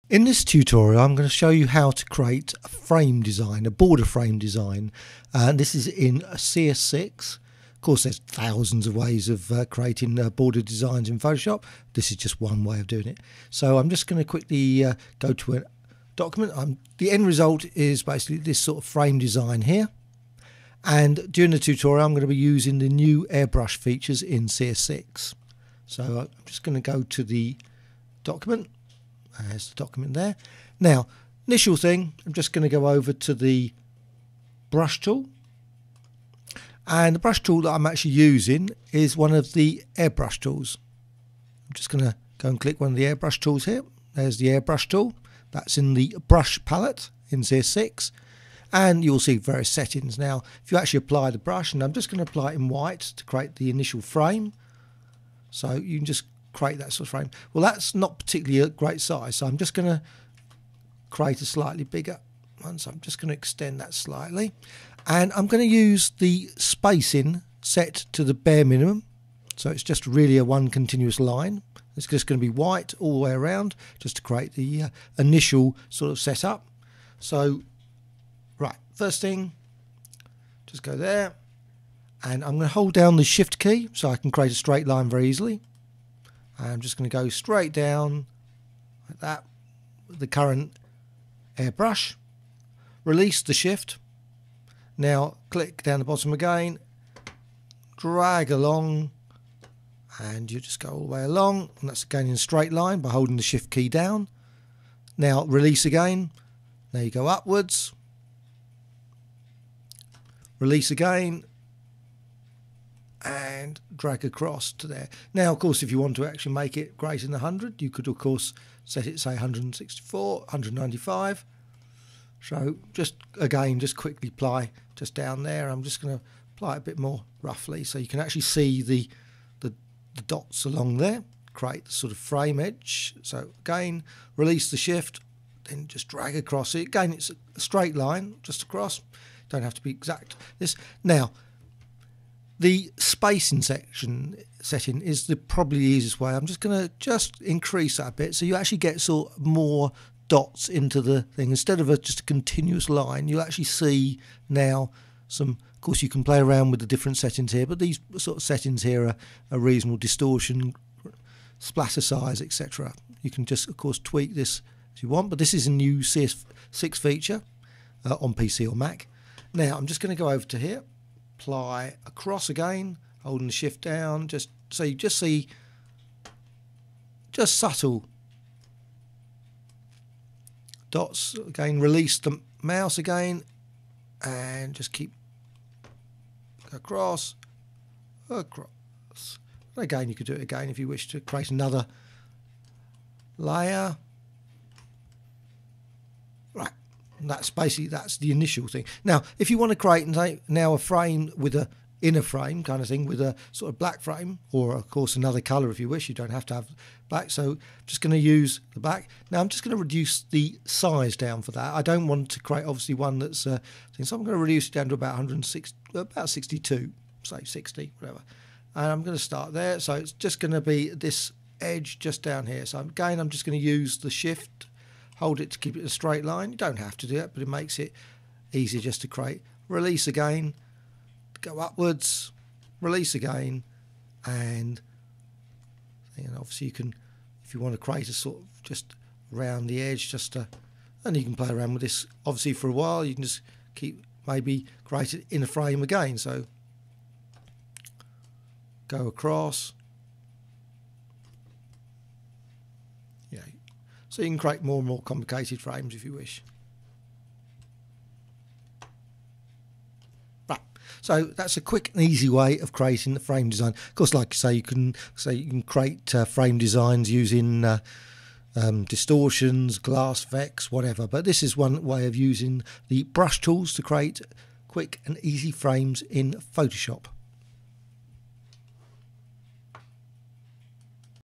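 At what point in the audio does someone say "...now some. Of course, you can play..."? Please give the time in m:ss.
2:34.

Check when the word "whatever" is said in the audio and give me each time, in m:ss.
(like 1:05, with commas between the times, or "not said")
3:37, 4:30.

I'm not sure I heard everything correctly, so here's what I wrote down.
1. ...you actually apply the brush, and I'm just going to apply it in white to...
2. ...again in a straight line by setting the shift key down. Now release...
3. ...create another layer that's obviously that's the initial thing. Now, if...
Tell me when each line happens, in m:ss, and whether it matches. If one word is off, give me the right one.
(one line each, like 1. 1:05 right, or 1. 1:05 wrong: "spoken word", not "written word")
1. 0:50 right
2. 1:42 wrong: "holding", not "setting"
3. 3:11 wrong: "basically", not "obviously".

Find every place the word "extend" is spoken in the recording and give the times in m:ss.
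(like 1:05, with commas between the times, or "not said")
1:03.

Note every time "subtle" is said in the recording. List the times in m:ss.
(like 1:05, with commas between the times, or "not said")
2:57.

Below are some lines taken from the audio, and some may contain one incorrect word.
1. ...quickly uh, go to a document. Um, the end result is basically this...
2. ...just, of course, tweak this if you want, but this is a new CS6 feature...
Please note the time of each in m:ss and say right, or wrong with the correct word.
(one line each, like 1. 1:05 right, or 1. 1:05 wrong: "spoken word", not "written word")
1. 0:14 right
2. 2:43 right.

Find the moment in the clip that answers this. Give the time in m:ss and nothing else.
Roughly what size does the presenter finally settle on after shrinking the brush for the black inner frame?
3:37.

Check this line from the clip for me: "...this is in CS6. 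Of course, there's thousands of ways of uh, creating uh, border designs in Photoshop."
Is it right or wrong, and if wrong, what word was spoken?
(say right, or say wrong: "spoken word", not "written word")
right.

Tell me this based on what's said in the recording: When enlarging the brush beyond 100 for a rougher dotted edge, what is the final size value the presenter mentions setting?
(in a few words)
195.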